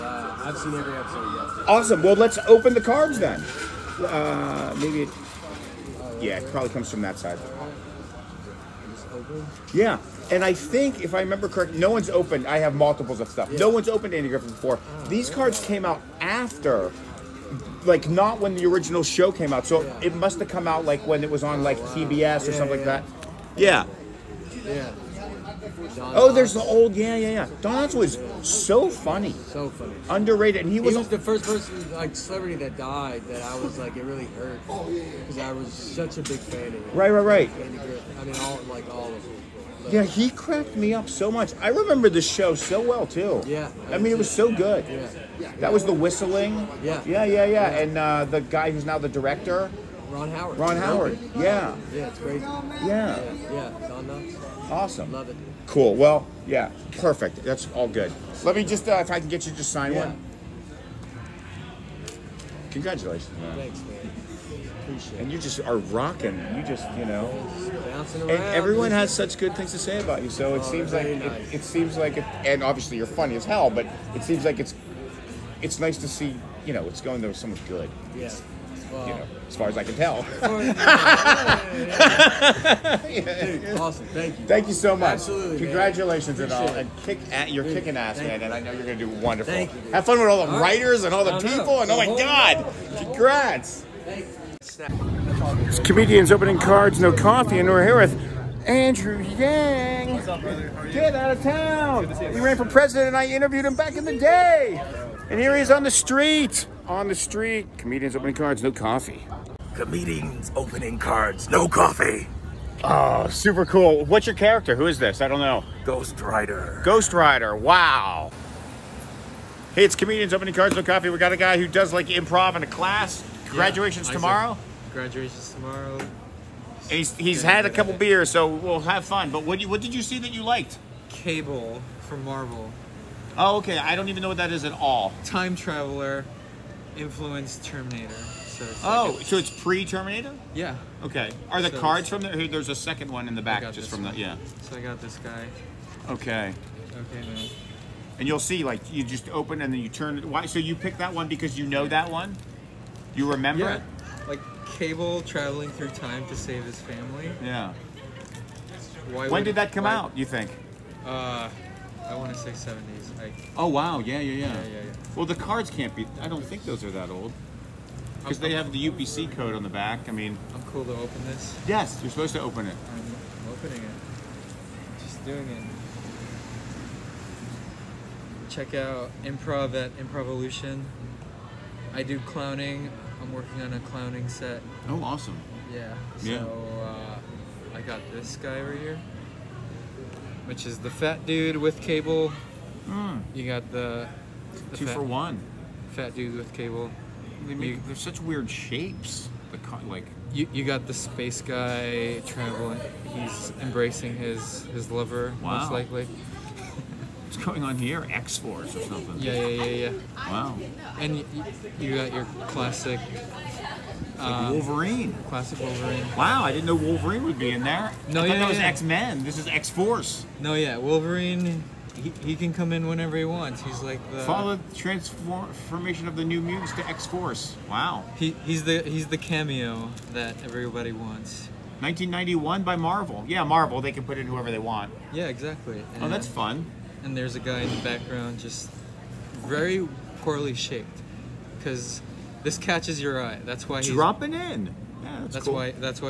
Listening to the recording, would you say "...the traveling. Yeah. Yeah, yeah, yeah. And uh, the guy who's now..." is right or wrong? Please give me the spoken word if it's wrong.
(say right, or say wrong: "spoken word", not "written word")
wrong: "whistling", not "traveling".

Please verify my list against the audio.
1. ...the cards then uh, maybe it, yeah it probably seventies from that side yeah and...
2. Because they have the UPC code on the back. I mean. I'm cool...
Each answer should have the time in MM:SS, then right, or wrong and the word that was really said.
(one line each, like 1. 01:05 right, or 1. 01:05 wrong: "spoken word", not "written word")
1. 00:02 wrong: "comes", not "seventies"
2. 02:48 right.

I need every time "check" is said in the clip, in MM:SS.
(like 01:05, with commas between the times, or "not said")
02:58.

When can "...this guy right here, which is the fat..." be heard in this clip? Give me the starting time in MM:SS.
03:08.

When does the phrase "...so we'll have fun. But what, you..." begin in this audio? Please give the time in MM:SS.
02:08.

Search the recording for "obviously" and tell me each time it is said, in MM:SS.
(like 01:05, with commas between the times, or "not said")
01:12.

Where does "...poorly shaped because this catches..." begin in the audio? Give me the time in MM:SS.
04:00.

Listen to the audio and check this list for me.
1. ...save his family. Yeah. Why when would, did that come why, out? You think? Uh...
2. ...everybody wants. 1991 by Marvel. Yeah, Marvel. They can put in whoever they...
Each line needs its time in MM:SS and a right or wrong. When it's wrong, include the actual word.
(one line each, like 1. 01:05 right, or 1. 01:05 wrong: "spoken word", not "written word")
1. 02:36 right
2. 03:50 right.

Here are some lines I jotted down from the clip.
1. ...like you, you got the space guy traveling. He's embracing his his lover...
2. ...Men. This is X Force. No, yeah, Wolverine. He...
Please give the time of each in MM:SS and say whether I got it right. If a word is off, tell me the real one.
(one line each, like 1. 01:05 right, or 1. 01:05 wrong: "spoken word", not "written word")
1. 03:19 right
2. 03:38 right.